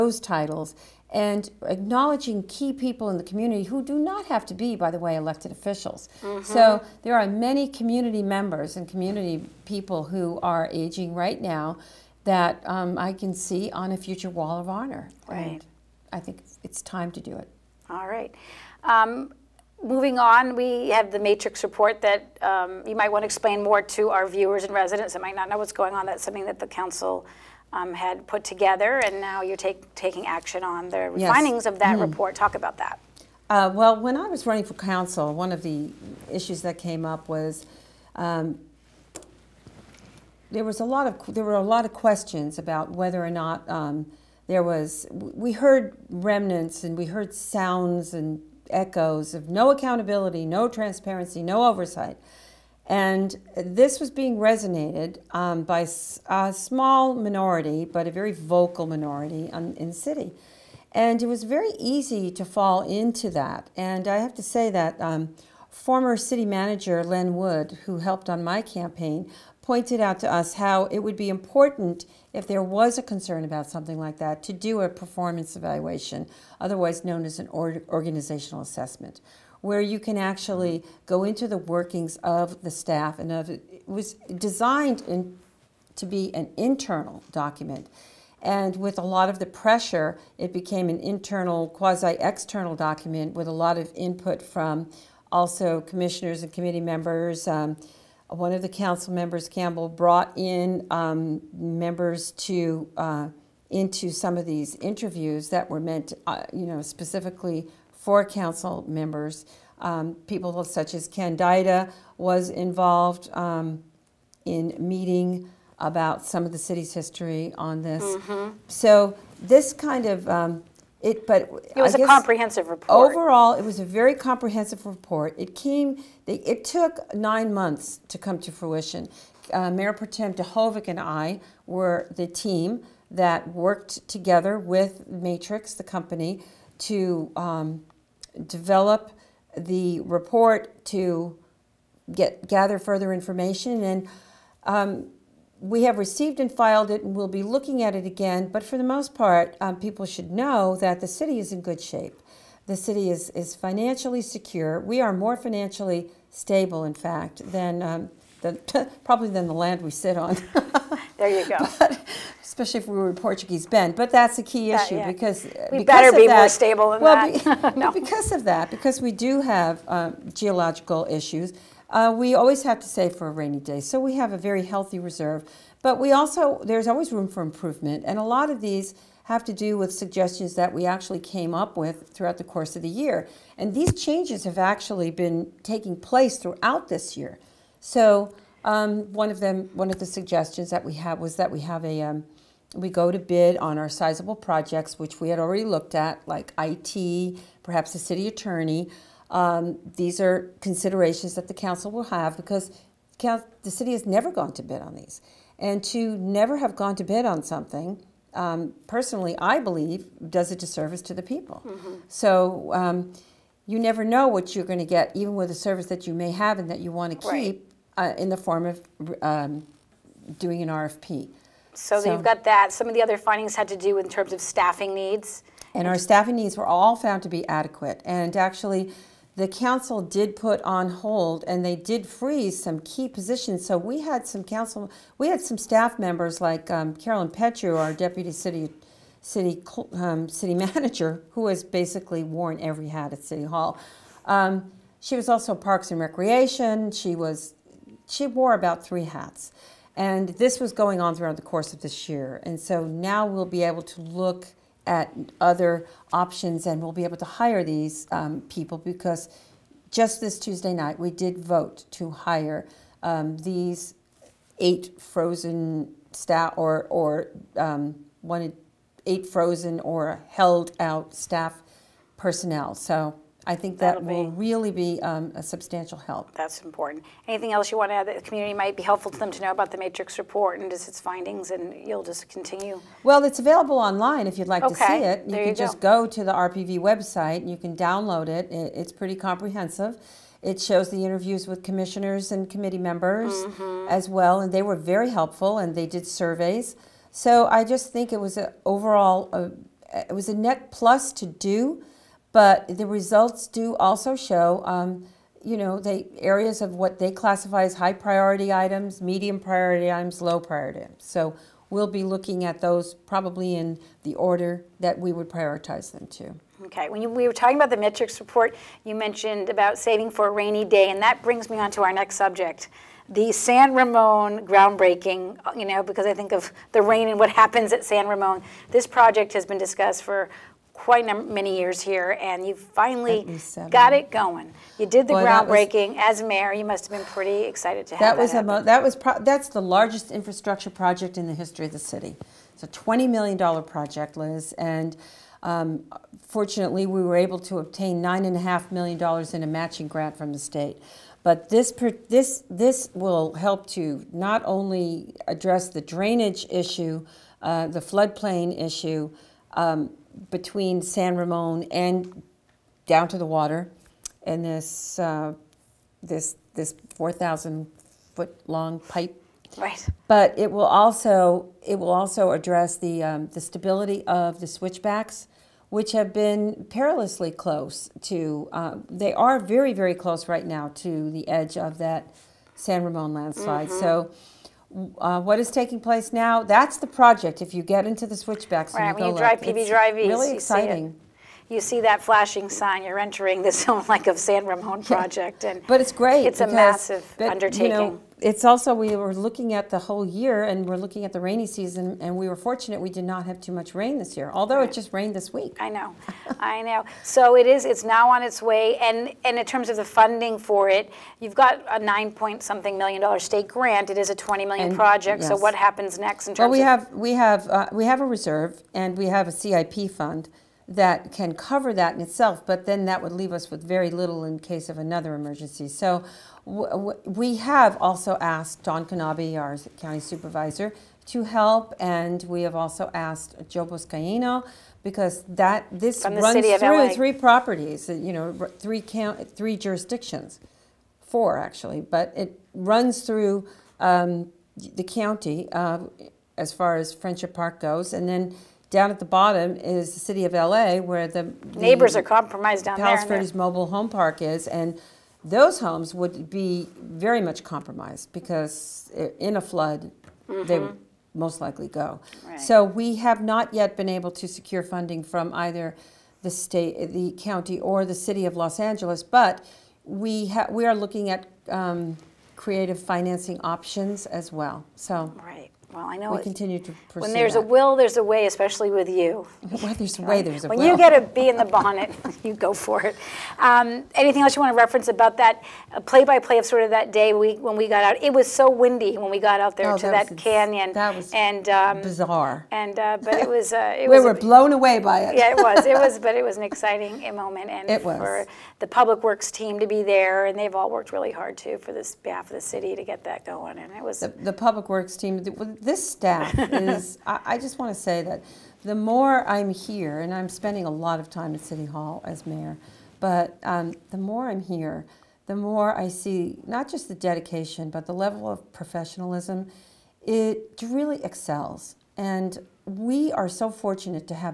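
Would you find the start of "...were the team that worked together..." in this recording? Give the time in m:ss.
2:11.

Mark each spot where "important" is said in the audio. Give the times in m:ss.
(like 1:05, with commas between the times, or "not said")
1:11, 4:36.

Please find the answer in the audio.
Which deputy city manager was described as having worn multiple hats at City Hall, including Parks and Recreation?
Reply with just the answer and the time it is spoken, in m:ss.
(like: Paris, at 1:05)
Carolyn Petru, at 3:56.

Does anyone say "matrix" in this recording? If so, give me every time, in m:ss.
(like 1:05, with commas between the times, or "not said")
0:21, 2:15, 4:39, 5:17.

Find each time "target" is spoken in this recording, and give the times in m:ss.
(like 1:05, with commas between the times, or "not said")
not said.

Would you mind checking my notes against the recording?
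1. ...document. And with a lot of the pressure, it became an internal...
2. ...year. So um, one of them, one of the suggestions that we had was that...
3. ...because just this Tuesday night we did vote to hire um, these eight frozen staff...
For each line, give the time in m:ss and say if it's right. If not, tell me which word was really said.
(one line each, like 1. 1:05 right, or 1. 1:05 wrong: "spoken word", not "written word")
1. 1:27 right
2. 3:07 right
3. 4:18 right.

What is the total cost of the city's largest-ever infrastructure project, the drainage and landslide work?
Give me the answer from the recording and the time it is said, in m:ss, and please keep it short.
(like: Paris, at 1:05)
$20 million, at 5:42.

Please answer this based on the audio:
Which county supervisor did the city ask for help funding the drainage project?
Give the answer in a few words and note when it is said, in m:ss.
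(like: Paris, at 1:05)
Don Knabe, at 7:08.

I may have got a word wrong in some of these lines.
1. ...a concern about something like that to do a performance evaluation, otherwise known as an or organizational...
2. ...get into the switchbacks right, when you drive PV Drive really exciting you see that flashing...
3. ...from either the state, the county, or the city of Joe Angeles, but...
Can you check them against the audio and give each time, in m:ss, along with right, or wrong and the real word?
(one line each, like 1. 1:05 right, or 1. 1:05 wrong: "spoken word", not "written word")
1. 1:12 right
2. 6:27 right
3. 7:45 wrong: "Los", not "Joe".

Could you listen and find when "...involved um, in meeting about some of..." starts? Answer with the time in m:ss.
1:52.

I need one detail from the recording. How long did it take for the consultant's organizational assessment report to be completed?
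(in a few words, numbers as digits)
9 months.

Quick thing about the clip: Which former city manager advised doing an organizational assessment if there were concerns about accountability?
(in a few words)
Len Wood.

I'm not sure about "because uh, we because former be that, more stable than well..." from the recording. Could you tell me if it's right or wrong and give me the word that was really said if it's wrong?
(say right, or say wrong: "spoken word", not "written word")
wrong: "better", not "former".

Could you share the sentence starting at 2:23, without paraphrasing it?
And um, we have received and filed it, and we'll be looking at it again.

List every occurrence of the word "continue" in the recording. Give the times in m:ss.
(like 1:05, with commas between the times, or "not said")
4:42, 7:56.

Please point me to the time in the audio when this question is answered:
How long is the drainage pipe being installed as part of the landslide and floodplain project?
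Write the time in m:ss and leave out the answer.
6:06.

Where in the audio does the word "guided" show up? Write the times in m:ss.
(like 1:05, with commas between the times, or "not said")
not said.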